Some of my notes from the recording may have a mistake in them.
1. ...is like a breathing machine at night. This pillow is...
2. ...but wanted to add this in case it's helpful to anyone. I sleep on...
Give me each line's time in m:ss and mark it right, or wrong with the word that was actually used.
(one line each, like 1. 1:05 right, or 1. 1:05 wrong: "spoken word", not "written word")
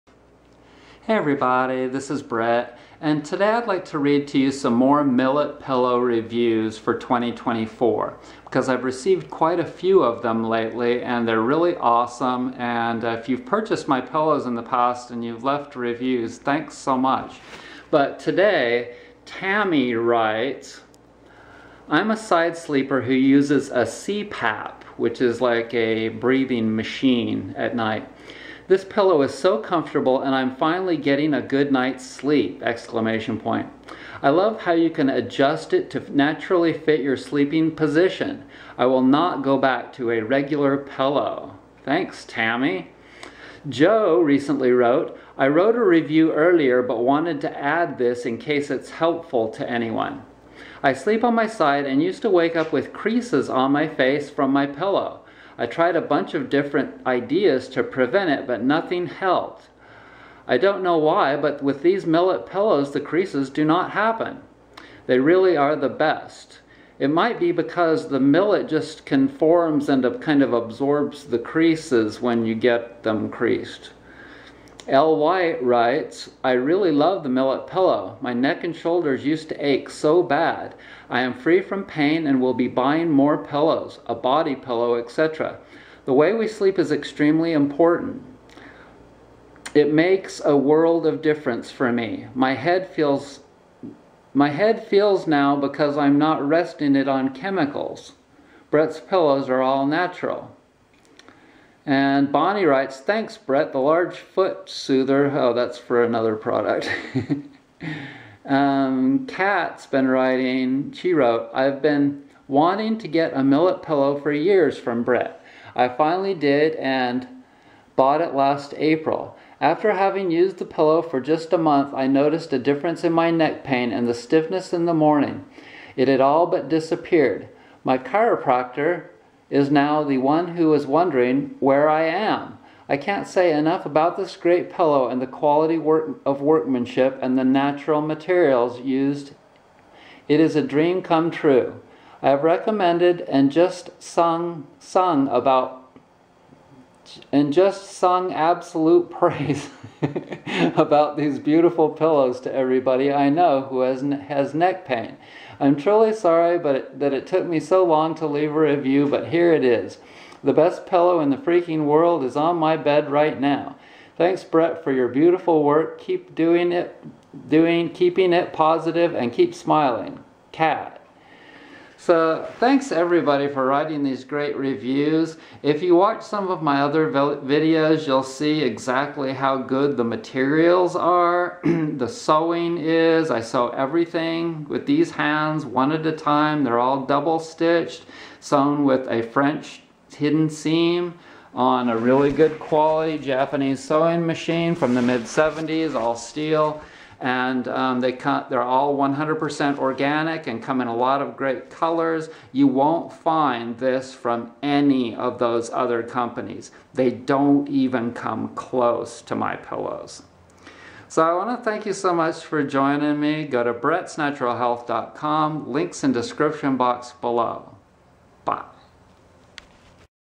1. 0:25 right
2. 0:46 right.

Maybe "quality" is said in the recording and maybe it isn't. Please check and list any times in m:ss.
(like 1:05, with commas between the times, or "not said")
2:15, 3:12.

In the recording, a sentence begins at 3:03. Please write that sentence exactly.
I sew everything with these hands one at a time.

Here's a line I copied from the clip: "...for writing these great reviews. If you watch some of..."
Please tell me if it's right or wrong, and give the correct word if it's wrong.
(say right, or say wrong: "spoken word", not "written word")
right.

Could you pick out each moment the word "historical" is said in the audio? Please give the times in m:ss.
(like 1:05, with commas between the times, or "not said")
not said.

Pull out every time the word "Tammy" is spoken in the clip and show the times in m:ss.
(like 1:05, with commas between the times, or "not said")
0:19, 0:42.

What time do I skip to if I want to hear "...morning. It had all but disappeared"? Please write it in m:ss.
2:04.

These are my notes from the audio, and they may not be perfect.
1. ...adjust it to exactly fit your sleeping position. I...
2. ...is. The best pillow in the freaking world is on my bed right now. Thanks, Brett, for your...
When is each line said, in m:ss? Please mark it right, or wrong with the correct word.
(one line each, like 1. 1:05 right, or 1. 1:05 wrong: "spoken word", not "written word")
1. 0:35 wrong: "naturally", not "exactly"
2. 2:39 right.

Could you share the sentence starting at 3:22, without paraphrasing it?
You won't find this from any of those other companies.